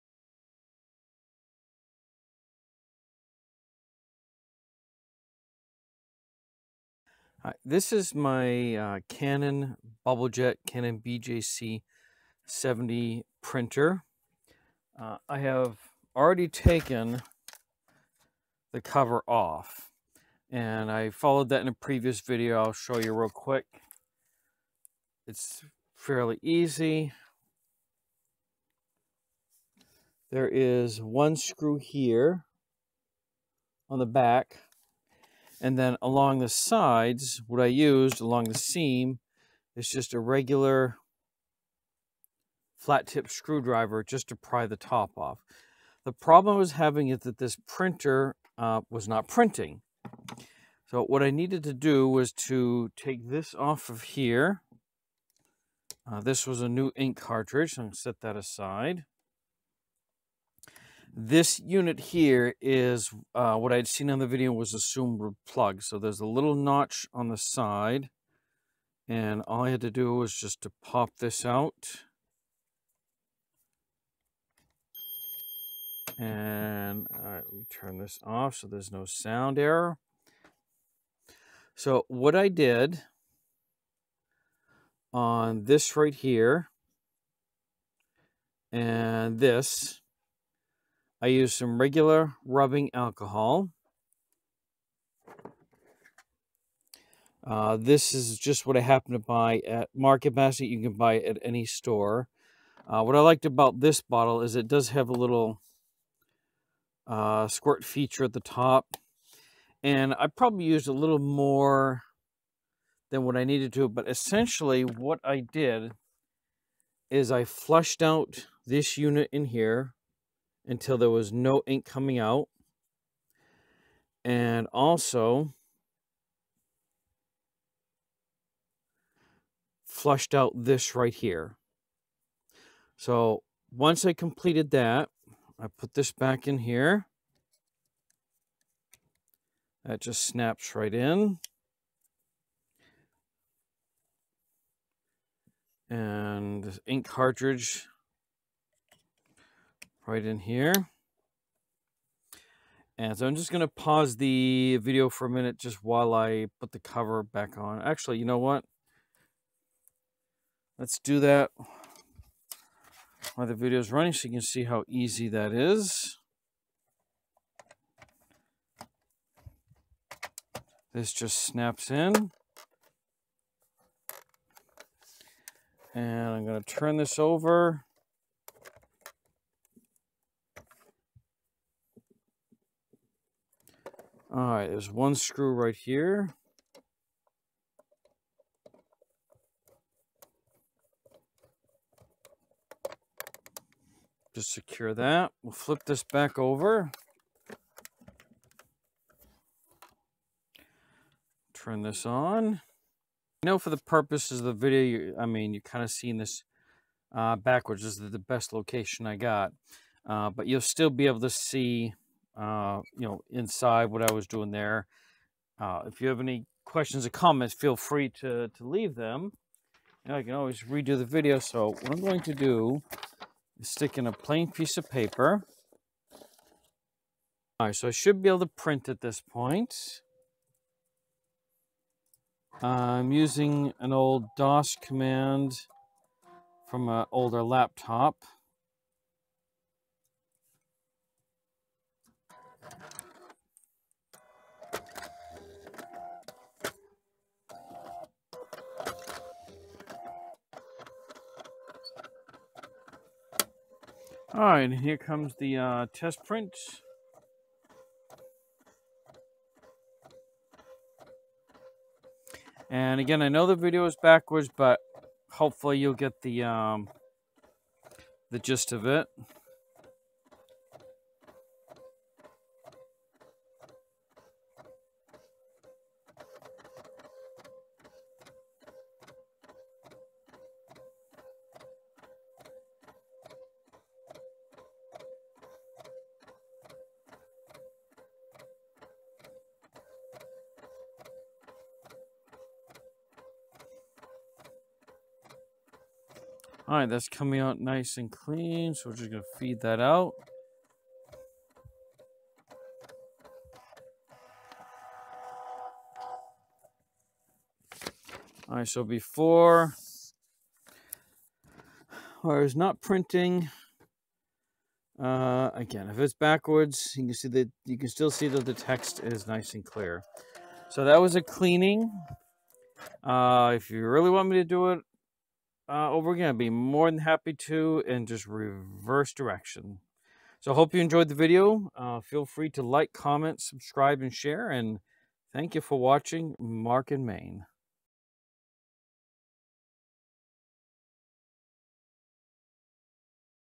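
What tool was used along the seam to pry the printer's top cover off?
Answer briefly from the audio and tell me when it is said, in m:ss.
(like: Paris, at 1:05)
Flat tip screwdriver, at 0:42.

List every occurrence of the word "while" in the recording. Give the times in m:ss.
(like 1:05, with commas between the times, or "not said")
2:35, 2:43.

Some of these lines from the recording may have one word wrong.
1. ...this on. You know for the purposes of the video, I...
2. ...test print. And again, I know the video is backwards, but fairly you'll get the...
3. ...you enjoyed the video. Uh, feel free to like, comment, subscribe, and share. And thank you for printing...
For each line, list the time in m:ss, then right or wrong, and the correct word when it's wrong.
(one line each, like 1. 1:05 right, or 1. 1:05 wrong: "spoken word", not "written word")
1. 3:21 right
2. 4:15 wrong: "hopefully", not "fairly"
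3. 5:30 wrong: "watching", not "printing".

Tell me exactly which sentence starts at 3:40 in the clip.
And I can always redo the video.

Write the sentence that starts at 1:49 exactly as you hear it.
And I probably used a little more than what I needed to.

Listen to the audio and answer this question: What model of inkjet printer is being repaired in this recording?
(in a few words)
Canon BJC 70.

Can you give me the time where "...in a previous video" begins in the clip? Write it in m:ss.
0:21.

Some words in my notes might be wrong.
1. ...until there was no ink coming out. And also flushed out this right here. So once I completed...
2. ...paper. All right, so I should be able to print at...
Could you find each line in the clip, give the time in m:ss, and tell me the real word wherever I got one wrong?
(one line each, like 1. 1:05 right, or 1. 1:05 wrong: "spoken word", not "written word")
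1. 2:00 right
2. 3:44 right.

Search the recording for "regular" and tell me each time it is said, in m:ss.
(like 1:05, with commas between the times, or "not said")
0:40, 1:31.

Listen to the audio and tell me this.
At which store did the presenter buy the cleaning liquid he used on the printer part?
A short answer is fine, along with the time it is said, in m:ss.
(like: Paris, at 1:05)
Market Basket, at 1:39.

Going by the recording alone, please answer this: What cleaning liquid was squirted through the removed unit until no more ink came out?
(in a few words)
Rubbing alcohol.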